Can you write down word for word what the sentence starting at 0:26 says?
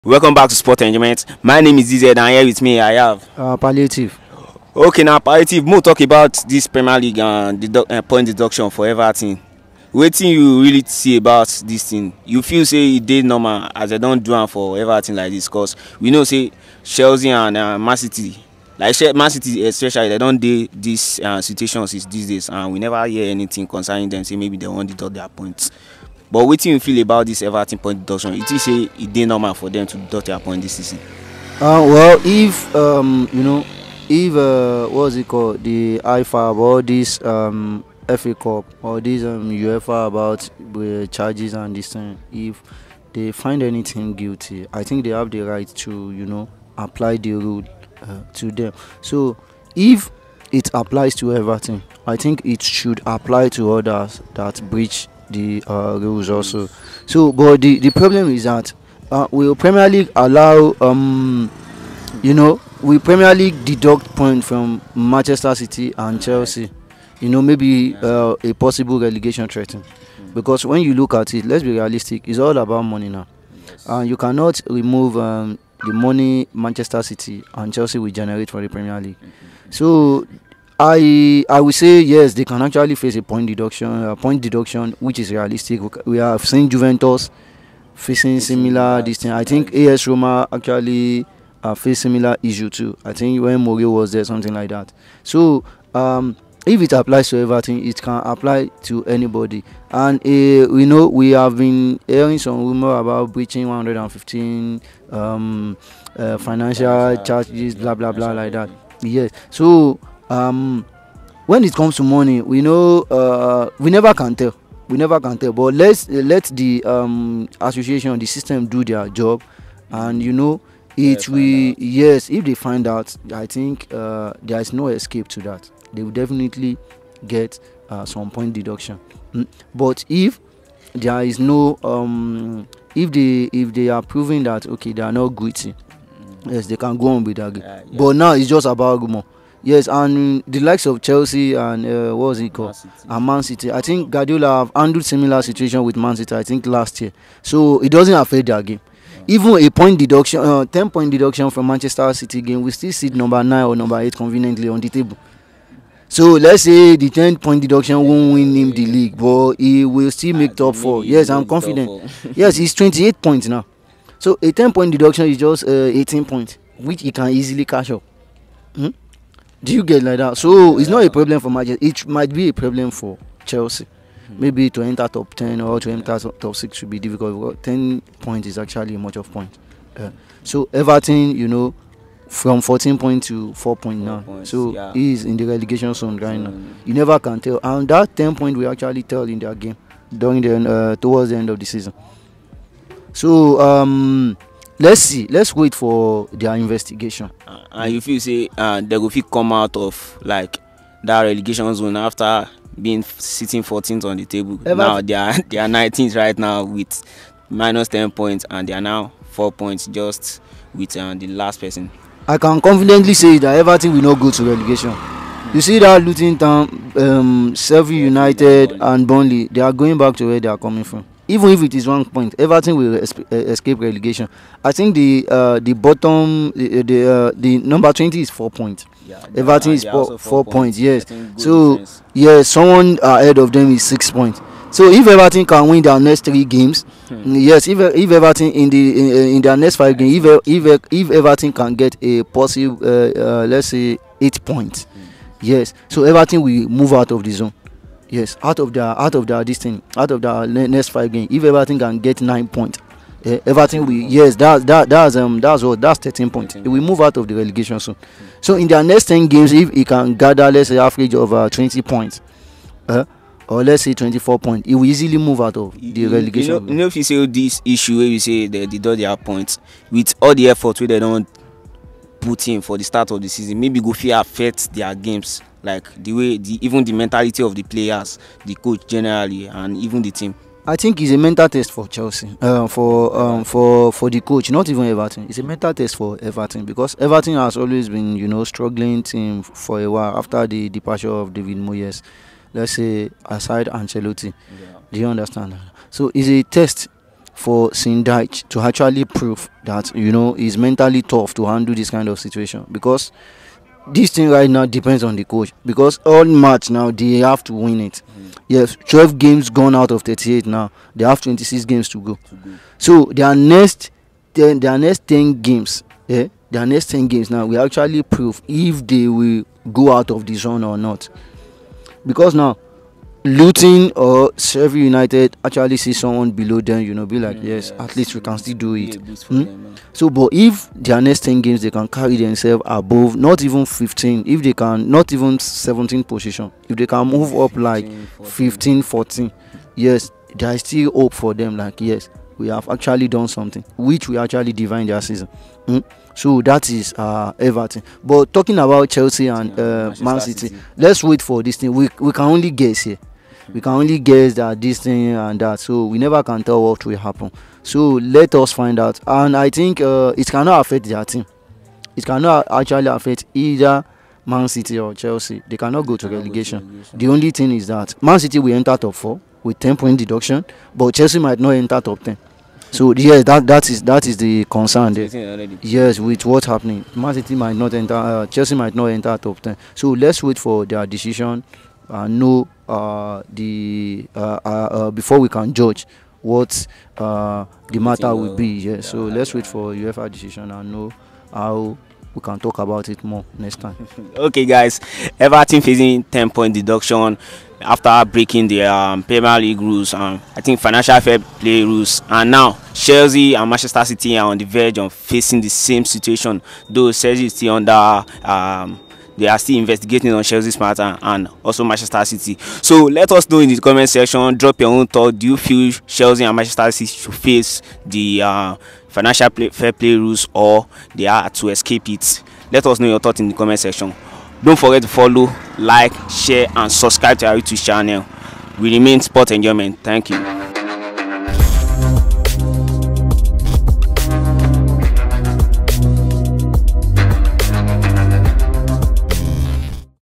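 but what do you feel about this everton point deduction you a say normal for them to deduct their point dis season.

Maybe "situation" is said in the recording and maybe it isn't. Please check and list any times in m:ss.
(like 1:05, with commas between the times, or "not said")
0:21, 2:25, 5:02, 6:45.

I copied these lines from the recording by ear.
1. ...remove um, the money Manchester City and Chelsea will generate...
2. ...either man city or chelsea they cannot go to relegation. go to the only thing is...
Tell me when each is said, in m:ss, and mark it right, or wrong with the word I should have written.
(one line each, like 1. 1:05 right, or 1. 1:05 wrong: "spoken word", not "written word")
1. 1:14 right
2. 6:03 right.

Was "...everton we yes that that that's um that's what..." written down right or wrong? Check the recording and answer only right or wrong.
right.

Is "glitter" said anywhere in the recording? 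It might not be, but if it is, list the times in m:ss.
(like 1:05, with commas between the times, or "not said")
not said.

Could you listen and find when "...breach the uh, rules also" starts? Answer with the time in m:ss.
0:54.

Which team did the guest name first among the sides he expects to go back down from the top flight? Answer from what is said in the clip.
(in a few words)
Luton Town.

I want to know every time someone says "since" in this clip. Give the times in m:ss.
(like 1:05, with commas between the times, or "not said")
0:21.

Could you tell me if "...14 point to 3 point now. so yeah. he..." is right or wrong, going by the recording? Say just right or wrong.
wrong.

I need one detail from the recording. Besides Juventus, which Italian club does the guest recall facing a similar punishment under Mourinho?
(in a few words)
AS Roma.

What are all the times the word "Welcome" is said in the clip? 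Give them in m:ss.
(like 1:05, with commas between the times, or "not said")
0:00.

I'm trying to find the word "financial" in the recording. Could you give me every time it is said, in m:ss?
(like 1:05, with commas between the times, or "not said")
1:46, 6:40, 6:58.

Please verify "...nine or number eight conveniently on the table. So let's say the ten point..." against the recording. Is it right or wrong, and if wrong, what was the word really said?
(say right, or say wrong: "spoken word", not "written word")
right.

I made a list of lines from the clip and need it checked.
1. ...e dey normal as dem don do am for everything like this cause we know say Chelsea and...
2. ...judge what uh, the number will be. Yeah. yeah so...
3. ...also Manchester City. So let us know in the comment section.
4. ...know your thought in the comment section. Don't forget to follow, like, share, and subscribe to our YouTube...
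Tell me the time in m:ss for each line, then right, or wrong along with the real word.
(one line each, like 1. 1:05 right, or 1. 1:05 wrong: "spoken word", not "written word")
1. 0:12 right
2. 6:25 wrong: "matter", not "number"
3. 6:51 right
4. 7:02 right.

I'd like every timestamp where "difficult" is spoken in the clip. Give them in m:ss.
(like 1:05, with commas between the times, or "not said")
2:56.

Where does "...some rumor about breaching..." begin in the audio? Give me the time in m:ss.
1:42.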